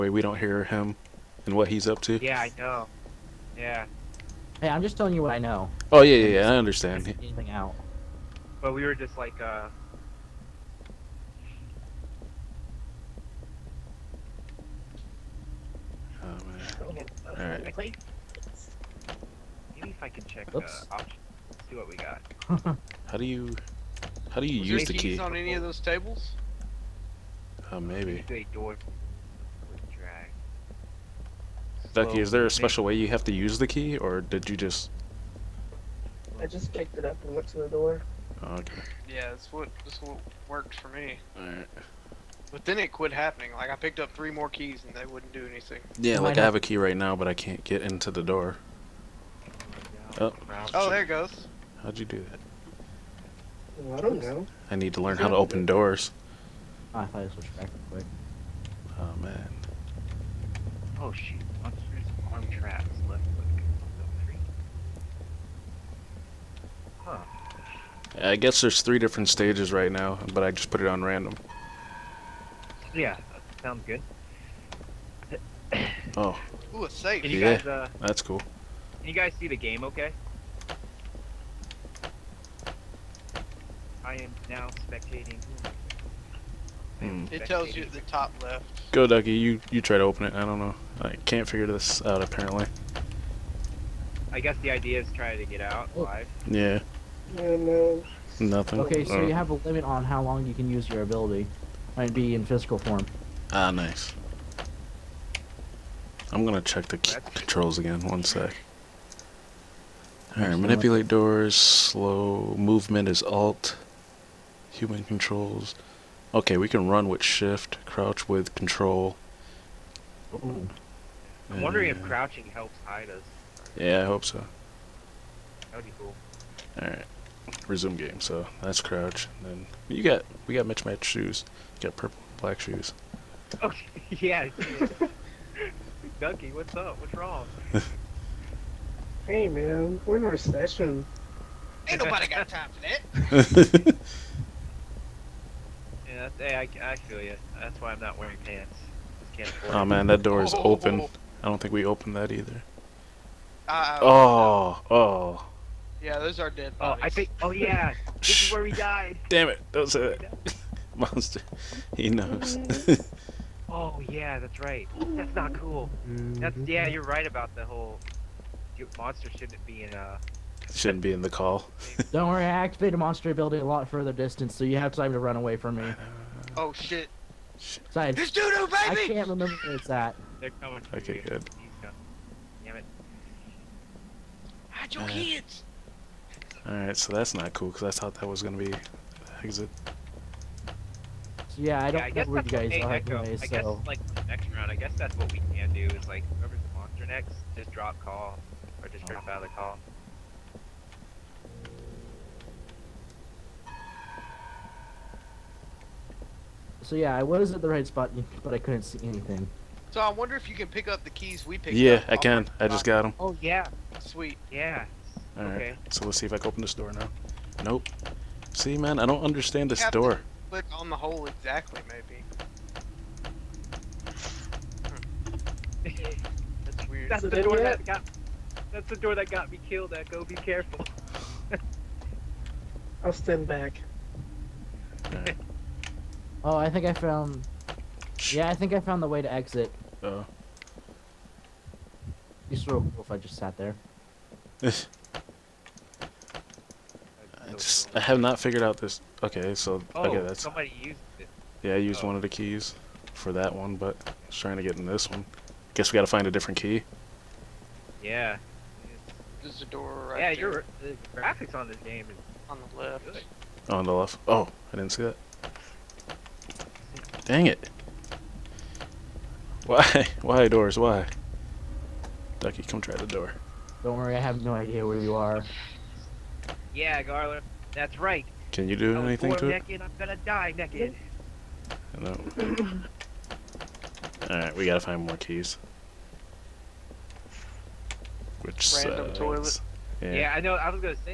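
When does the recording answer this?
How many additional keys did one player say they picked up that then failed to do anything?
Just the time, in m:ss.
0:43.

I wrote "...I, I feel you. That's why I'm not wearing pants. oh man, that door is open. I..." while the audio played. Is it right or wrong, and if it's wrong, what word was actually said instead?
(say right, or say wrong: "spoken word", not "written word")
right.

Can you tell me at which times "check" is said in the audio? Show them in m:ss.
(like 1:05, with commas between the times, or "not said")
0:20, 1:46.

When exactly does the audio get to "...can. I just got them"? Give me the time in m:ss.
3:32.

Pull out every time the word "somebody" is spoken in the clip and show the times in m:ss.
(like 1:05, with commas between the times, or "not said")
4:10.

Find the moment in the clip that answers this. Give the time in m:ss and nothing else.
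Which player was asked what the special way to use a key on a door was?
0:31.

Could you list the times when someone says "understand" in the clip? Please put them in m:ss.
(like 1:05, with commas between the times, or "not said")
0:06, 3:39.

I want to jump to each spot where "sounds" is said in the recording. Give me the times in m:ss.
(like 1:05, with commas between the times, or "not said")
1:13.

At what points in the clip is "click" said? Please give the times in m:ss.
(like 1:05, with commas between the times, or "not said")
1:03, 3:40.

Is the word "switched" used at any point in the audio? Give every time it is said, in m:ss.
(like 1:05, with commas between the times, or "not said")
0:57.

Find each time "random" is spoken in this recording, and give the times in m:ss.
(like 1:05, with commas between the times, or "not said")
1:11, 4:48.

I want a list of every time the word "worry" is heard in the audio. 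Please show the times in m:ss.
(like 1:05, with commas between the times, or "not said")
2:52, 4:33.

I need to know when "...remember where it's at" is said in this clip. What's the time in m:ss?
2:59.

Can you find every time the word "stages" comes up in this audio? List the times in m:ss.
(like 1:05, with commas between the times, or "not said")
1:09.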